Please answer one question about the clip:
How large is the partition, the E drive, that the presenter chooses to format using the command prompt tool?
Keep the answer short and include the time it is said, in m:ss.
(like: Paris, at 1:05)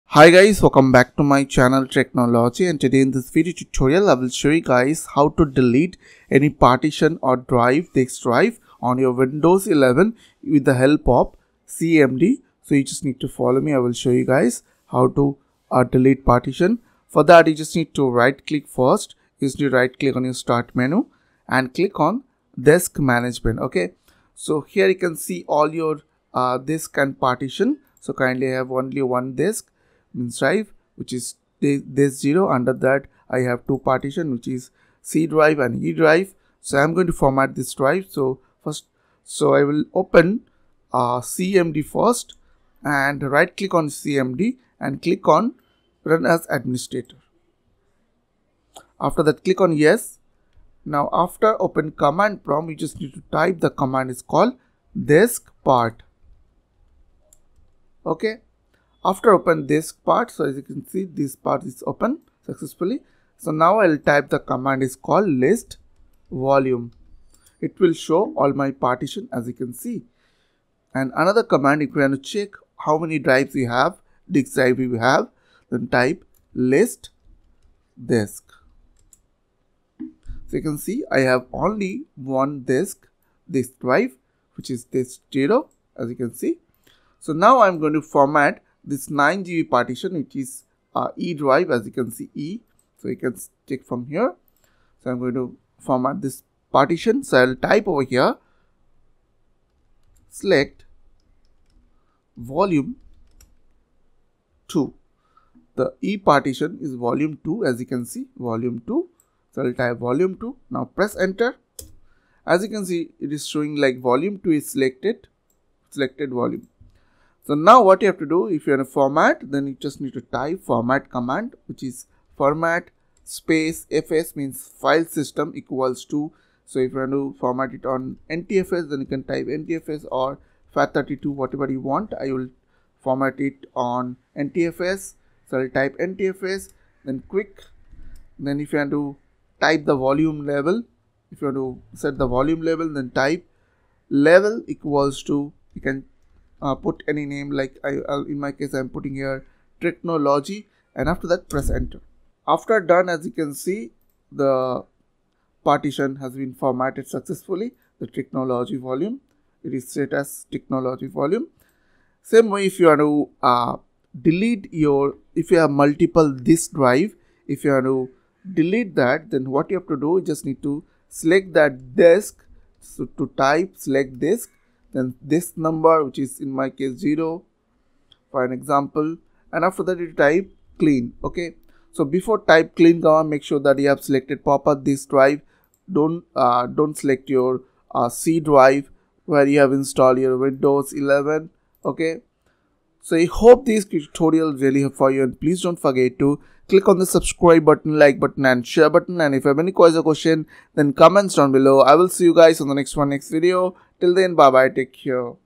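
9 GB, at 1:29.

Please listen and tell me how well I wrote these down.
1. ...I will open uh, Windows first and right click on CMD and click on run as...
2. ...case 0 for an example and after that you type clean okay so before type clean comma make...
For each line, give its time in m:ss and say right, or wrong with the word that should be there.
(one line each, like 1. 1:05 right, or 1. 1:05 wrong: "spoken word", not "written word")
1. 0:39 wrong: "CMD", not "Windows"
2. 2:56 right.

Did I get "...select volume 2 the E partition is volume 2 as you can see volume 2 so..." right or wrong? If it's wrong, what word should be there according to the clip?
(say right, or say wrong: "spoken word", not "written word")
right.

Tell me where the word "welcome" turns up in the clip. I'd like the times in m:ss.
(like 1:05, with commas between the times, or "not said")
0:00.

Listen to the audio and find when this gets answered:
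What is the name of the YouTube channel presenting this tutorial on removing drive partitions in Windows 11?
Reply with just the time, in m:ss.
0:01.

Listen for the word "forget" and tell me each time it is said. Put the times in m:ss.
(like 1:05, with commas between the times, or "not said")
3:15.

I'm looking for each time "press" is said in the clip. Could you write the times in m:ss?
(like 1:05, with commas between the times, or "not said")
1:50, 2:31.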